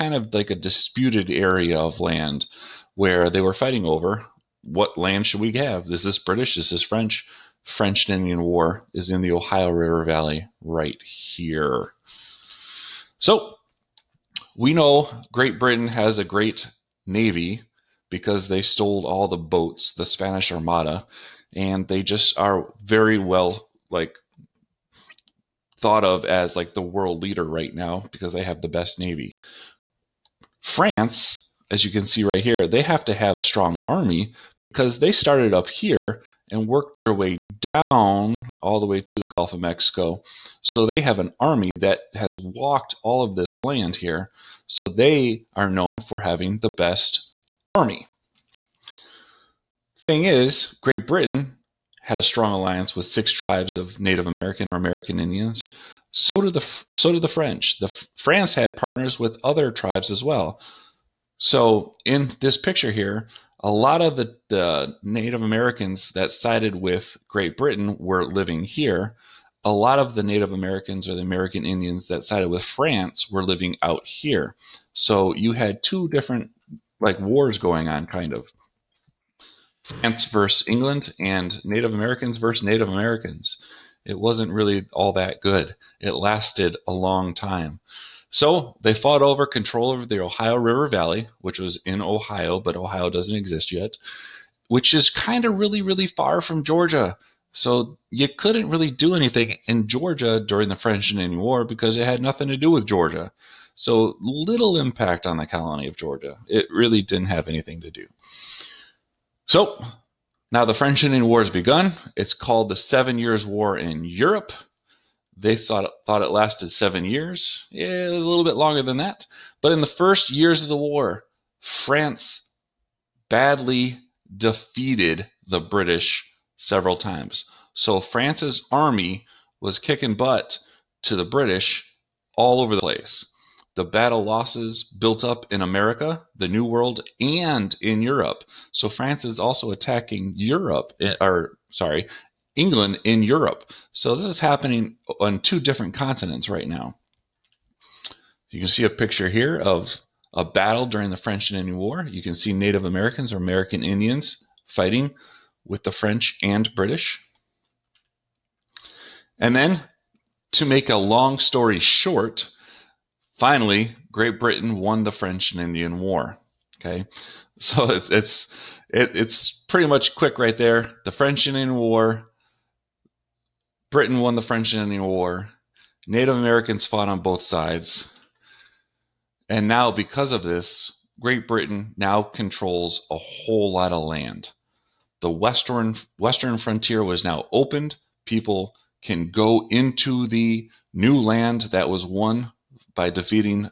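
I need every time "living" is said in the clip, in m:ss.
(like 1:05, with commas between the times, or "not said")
1:08, 1:13.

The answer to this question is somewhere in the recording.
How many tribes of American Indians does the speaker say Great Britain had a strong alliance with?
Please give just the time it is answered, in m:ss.
0:53.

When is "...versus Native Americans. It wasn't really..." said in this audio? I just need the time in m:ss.
1:22.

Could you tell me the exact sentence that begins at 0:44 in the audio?
So they are known for having the best army.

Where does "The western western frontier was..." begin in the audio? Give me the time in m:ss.
3:05.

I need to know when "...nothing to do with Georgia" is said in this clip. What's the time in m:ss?
1:42.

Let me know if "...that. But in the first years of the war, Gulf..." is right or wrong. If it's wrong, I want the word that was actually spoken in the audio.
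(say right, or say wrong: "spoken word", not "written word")
wrong: "France", not "Gulf".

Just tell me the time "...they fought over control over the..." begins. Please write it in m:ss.
1:28.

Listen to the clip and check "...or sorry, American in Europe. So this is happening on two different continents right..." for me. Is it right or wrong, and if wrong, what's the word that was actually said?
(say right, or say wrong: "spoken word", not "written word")
wrong: "England", not "American".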